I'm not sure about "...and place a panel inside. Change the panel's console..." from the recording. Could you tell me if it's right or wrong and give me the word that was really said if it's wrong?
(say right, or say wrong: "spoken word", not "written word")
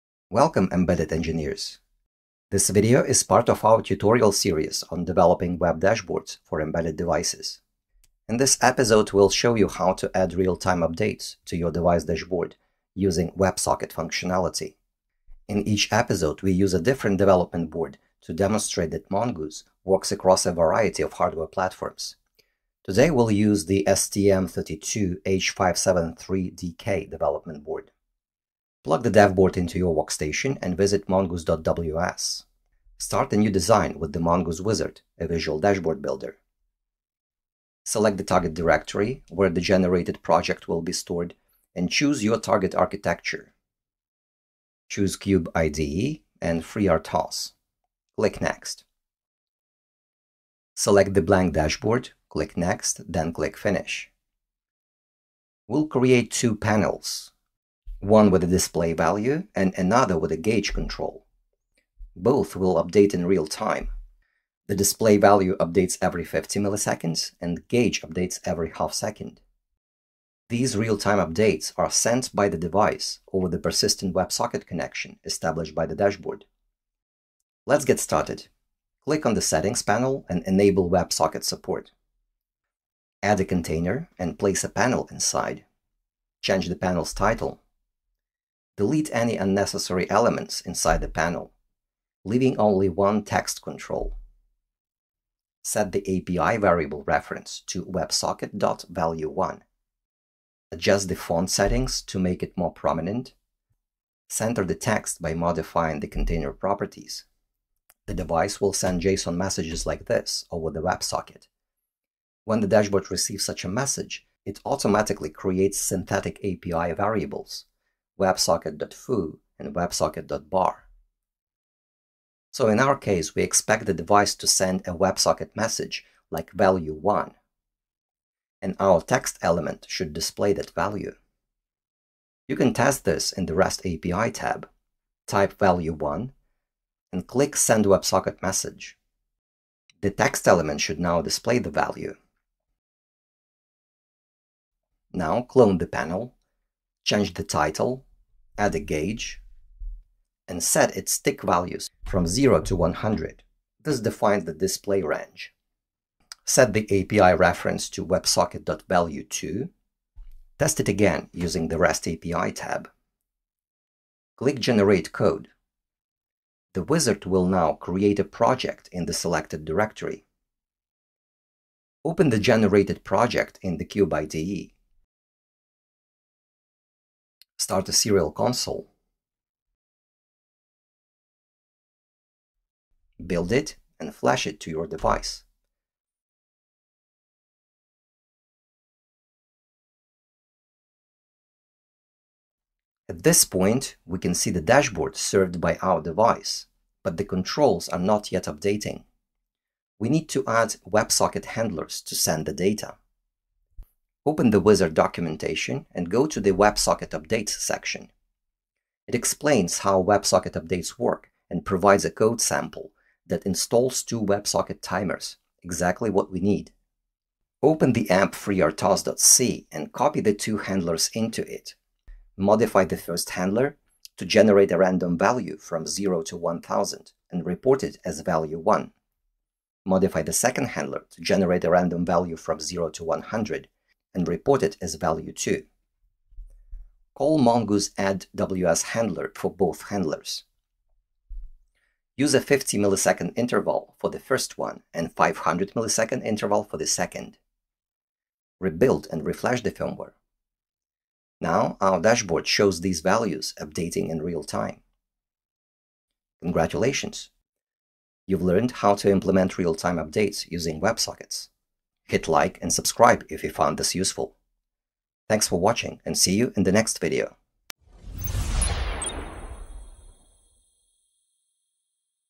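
wrong: "title", not "console".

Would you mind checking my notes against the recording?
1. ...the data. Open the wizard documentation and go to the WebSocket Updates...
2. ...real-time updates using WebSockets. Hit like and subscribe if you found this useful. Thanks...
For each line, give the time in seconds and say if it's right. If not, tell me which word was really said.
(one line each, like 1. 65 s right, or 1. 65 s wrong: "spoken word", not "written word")
1. 202 s right
2. 259 s right.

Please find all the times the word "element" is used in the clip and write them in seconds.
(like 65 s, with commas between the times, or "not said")
90 s, 129 s, 140 s.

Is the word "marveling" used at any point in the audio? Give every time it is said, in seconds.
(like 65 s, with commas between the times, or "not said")
not said.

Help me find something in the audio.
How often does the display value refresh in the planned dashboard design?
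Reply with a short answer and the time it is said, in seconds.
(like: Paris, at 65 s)
every 50 milliseconds, at 66 s.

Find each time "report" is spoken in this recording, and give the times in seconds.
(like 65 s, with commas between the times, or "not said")
227 s, 234 s.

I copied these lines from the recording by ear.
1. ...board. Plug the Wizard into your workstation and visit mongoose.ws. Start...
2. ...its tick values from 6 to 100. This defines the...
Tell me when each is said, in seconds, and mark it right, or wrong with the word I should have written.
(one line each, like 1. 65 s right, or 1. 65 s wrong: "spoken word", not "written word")
1. 27 s wrong: "Board", not "Wizard"
2. 150 s wrong: "0", not "6".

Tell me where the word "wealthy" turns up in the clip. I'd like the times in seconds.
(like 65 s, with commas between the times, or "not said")
not said.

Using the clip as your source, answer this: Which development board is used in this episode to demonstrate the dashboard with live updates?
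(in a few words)
STM32H573DK.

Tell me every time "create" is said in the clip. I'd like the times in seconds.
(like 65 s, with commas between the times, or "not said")
55 s, 115 s, 167 s.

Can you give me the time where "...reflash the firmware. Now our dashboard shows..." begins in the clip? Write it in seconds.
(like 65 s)
249 s.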